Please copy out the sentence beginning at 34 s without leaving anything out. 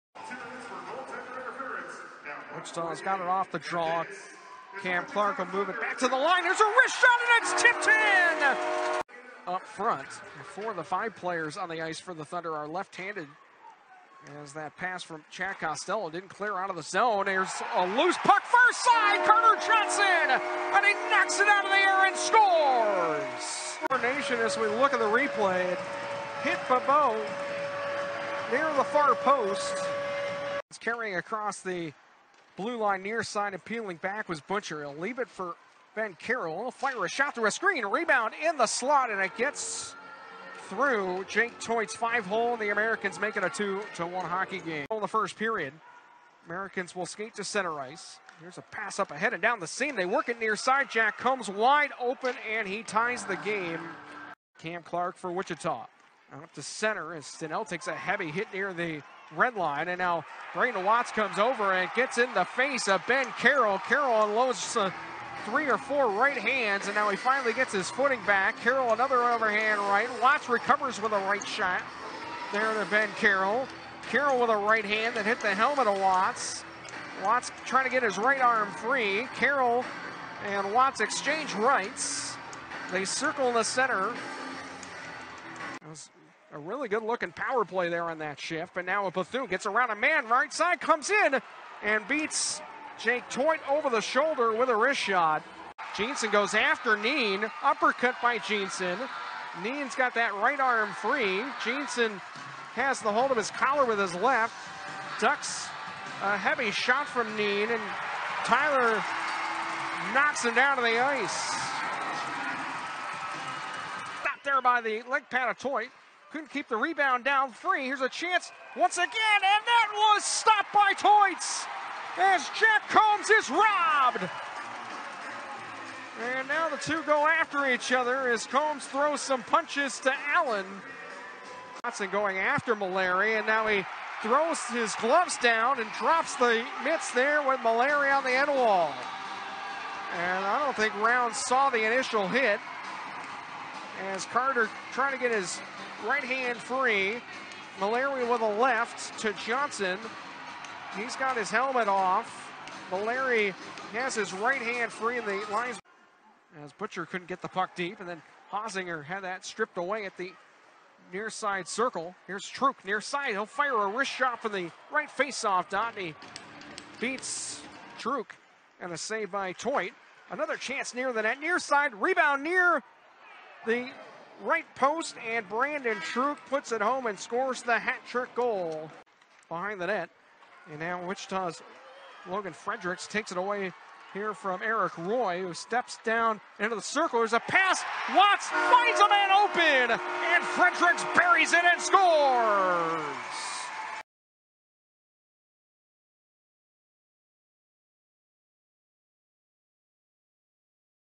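He'll leave it for Ben Carroll.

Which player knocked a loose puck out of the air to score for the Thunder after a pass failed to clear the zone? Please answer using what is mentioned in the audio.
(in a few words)
Carter Johnson.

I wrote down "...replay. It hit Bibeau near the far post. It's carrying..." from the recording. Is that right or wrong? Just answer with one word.
right.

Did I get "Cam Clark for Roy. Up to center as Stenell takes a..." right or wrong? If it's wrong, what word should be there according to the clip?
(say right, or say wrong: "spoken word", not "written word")
wrong: "Wichita", not "Roy".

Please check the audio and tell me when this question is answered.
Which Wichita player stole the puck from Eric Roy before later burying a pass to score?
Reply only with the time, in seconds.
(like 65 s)
182 s.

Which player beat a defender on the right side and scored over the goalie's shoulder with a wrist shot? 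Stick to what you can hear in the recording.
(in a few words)
Bethune.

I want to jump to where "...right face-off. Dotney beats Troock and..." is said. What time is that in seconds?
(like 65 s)
164 s.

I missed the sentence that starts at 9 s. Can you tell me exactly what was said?
Up front, four of the five players on the ice for the Thunder are left-handed.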